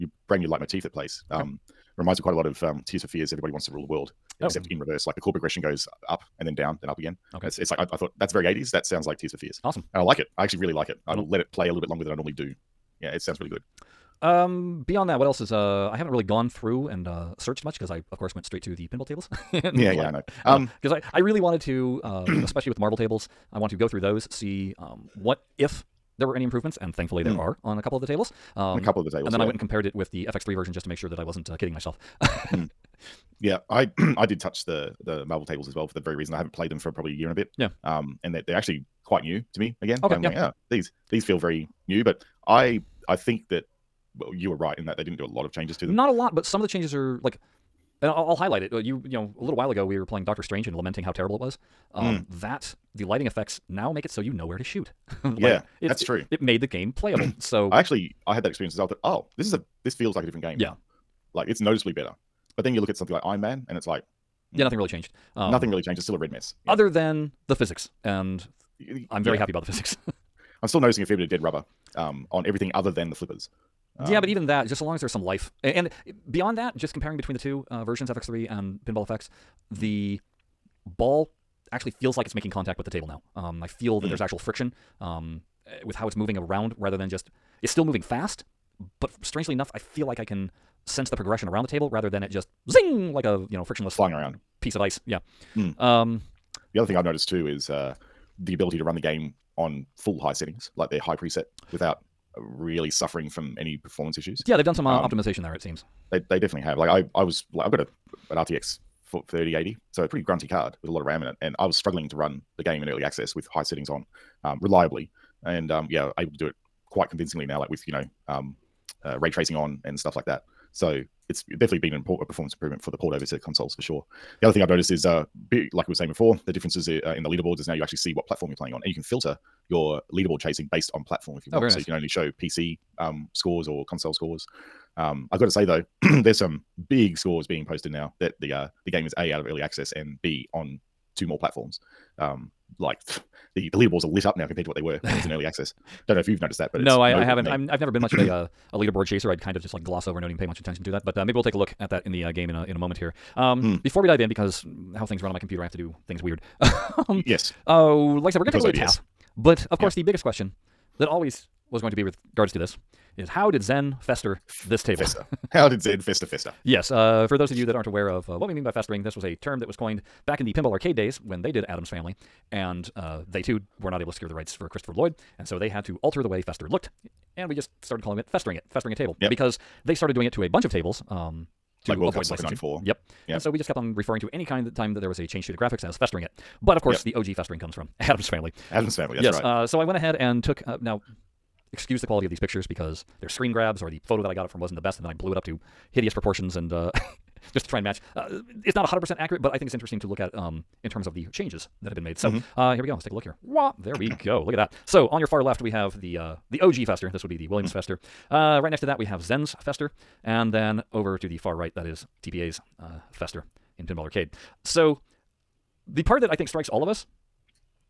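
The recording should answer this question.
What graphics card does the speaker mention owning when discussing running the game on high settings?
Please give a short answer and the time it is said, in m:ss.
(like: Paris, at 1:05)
RTX 3080, at 1:48.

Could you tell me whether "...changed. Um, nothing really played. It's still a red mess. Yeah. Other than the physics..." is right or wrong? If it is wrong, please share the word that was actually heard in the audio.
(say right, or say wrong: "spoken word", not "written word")
wrong: "changed", not "played".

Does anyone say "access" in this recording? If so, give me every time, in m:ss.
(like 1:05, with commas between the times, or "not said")
1:53, 2:19, 2:25.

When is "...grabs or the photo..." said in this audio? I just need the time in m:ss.
3:13.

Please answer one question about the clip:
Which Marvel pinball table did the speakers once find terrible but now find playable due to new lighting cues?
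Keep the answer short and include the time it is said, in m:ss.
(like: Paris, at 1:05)
Doctor Strange, at 0:50.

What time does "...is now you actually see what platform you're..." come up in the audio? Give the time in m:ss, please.
2:07.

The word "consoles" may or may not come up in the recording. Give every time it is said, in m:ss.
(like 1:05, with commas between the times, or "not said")
2:03, 2:13.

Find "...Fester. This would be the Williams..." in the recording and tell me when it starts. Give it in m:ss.
3:26.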